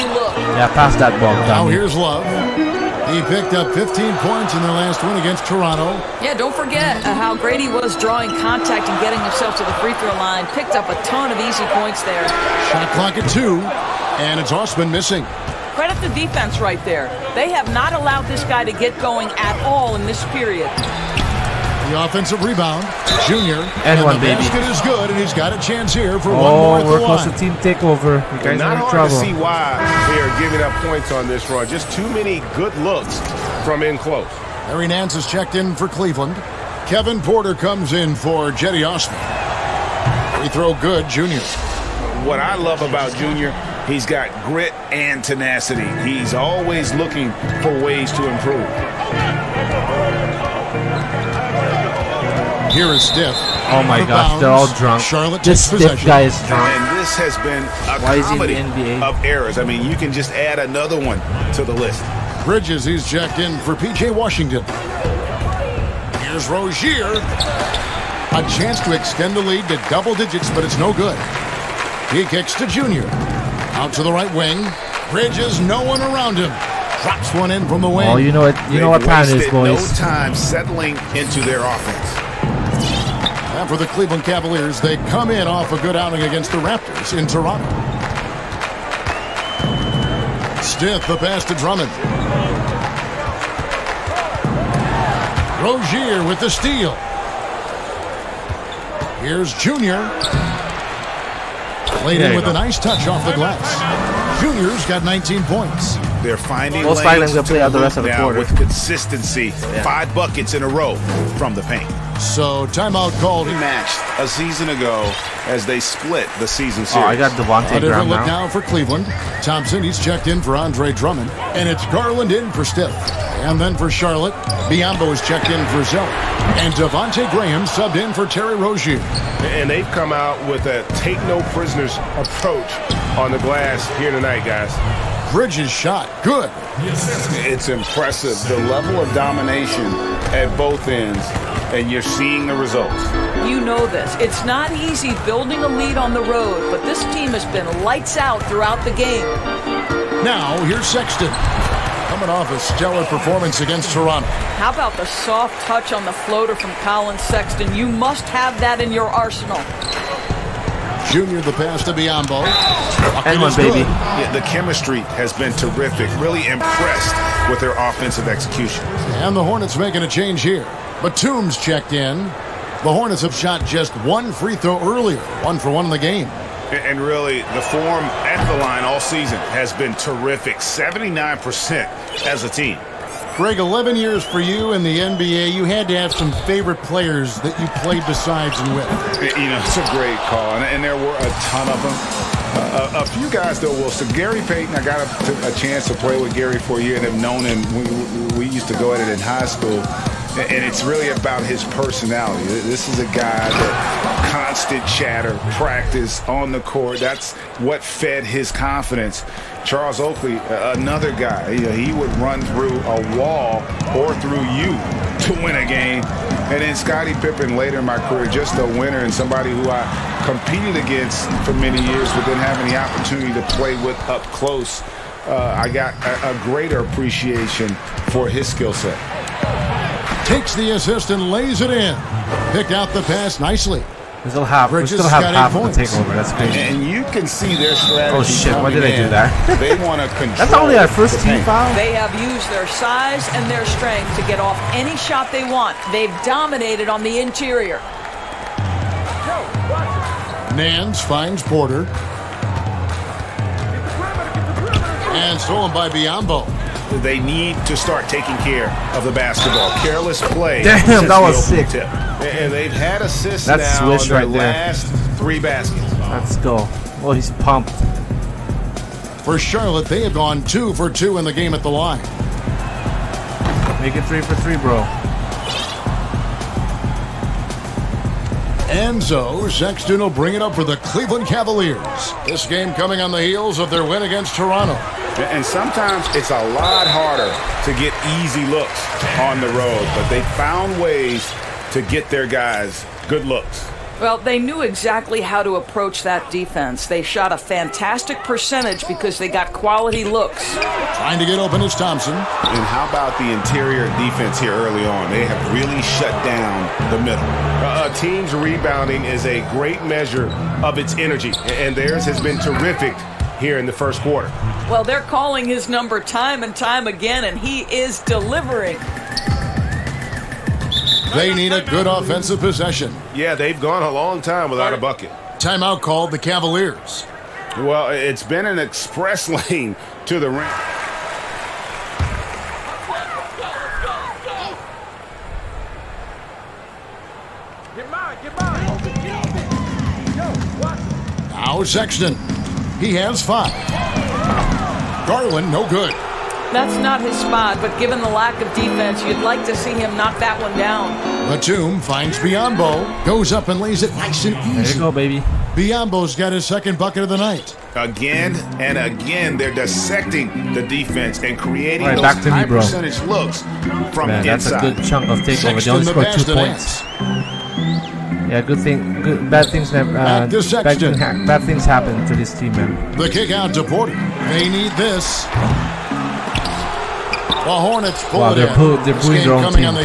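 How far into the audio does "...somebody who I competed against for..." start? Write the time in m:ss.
3:39.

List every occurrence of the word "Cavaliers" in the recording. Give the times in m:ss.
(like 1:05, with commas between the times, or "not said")
1:24, 4:41, 5:26.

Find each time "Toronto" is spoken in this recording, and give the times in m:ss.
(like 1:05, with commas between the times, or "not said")
0:05, 1:27, 2:33, 4:44.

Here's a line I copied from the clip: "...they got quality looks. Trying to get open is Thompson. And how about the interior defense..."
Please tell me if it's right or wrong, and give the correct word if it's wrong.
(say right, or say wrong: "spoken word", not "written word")
right.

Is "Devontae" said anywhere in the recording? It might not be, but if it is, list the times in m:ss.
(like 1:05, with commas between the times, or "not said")
1:57, 2:06.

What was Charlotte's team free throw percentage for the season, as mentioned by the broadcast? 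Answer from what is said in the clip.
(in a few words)
79%.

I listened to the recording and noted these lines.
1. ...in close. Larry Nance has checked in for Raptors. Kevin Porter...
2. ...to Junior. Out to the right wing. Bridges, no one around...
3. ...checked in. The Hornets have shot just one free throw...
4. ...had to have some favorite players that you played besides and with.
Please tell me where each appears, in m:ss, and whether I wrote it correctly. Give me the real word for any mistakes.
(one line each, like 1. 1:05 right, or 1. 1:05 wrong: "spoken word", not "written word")
1. 0:33 wrong: "Cleveland", not "Raptors"
2. 1:12 right
3. 2:51 right
4. 3:05 right.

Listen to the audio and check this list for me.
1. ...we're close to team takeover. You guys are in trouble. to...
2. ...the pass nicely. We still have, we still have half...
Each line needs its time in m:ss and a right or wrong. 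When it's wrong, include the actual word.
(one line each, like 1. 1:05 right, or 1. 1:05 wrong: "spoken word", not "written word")
1. 0:26 right
2. 3:52 right.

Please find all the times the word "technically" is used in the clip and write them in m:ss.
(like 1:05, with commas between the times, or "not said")
not said.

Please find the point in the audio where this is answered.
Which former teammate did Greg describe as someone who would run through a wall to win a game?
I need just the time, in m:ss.
3:29.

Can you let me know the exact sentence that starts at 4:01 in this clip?
They have used their size and their strength to get off any shot they want.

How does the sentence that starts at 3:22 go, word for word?
This is a guy that constant chatter, practice on the court.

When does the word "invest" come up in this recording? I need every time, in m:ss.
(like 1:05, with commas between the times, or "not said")
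not said.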